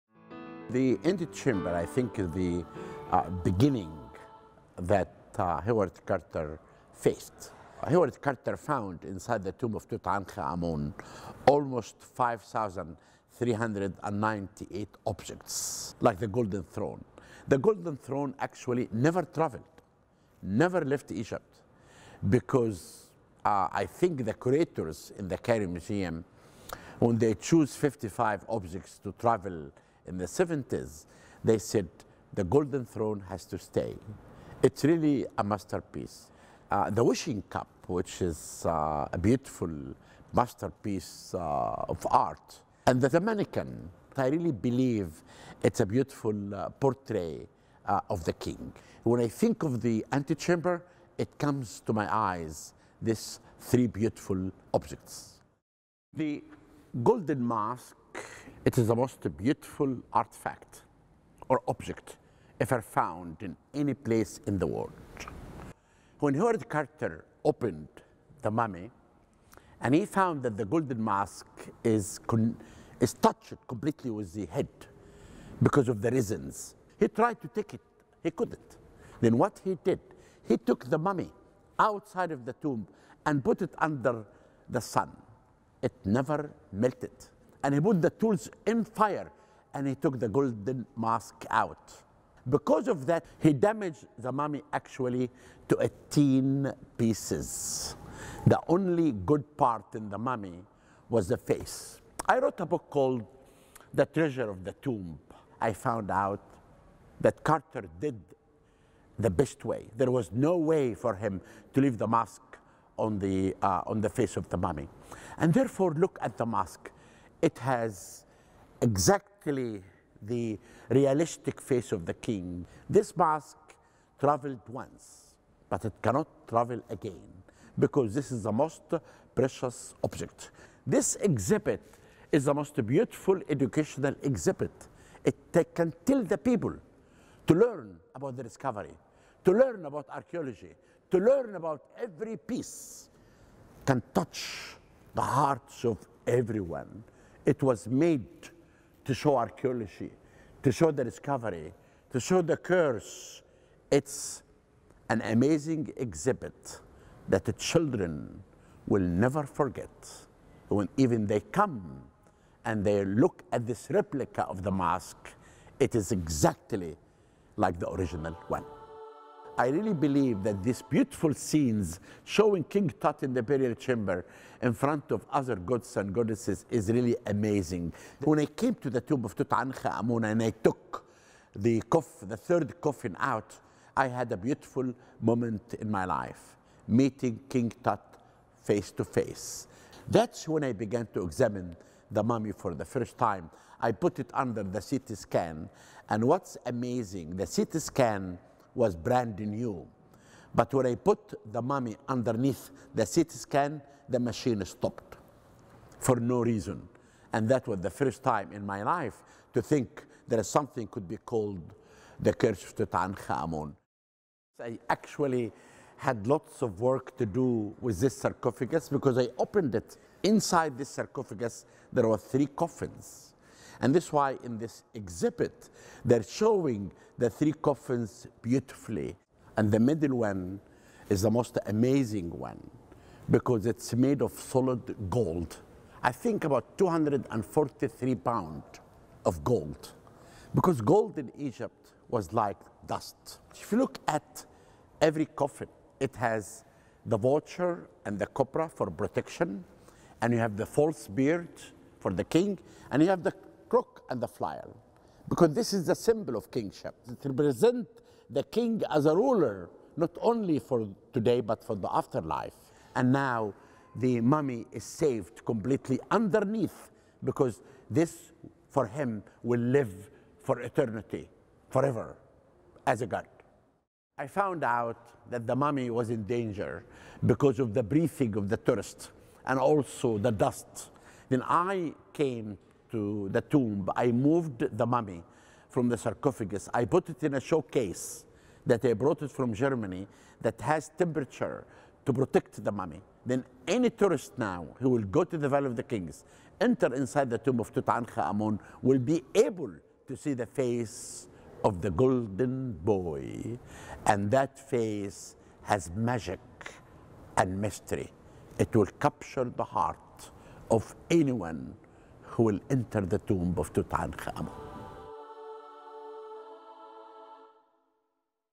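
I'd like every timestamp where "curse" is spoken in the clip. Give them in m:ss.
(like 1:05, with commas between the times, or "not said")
2:32, 3:32.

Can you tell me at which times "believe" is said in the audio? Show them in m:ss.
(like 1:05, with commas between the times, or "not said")
0:44, 2:49.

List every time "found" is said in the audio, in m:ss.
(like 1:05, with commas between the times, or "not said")
0:08, 1:02, 1:10, 1:45, 4:34.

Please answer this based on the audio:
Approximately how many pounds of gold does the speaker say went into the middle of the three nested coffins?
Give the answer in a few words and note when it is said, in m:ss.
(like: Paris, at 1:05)
243, at 3:56.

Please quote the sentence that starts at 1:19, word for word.
Then what he did, he took the mummy outside of the tomb and put it under the sun.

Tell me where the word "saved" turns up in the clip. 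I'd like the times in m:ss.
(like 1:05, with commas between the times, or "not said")
4:24.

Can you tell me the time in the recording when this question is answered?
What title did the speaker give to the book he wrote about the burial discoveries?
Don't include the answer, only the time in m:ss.
1:43.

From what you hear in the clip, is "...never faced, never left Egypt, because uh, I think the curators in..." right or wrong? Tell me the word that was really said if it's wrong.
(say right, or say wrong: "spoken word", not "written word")
wrong: "traveled", not "faced".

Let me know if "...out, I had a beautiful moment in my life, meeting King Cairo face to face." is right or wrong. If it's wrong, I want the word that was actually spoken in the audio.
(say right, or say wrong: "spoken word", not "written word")
wrong: "Tut", not "Cairo".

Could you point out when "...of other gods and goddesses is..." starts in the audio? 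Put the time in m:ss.
2:55.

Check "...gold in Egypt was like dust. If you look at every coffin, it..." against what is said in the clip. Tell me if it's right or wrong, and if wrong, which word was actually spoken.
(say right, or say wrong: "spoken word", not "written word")
right.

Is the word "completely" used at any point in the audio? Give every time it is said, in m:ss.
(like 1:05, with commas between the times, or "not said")
1:13, 4:25.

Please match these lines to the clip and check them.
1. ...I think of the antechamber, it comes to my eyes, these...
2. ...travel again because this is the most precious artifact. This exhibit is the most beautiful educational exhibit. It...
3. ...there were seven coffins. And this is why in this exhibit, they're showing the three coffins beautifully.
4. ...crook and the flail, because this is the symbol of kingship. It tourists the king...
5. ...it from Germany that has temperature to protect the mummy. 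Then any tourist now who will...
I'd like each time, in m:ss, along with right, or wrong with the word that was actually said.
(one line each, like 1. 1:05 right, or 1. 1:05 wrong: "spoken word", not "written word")
1. 0:49 right
2. 2:06 wrong: "object", not "artifact"
3. 3:41 wrong: "three", not "seven"
4. 4:13 wrong: "represents", not "tourists"
5. 4:49 right.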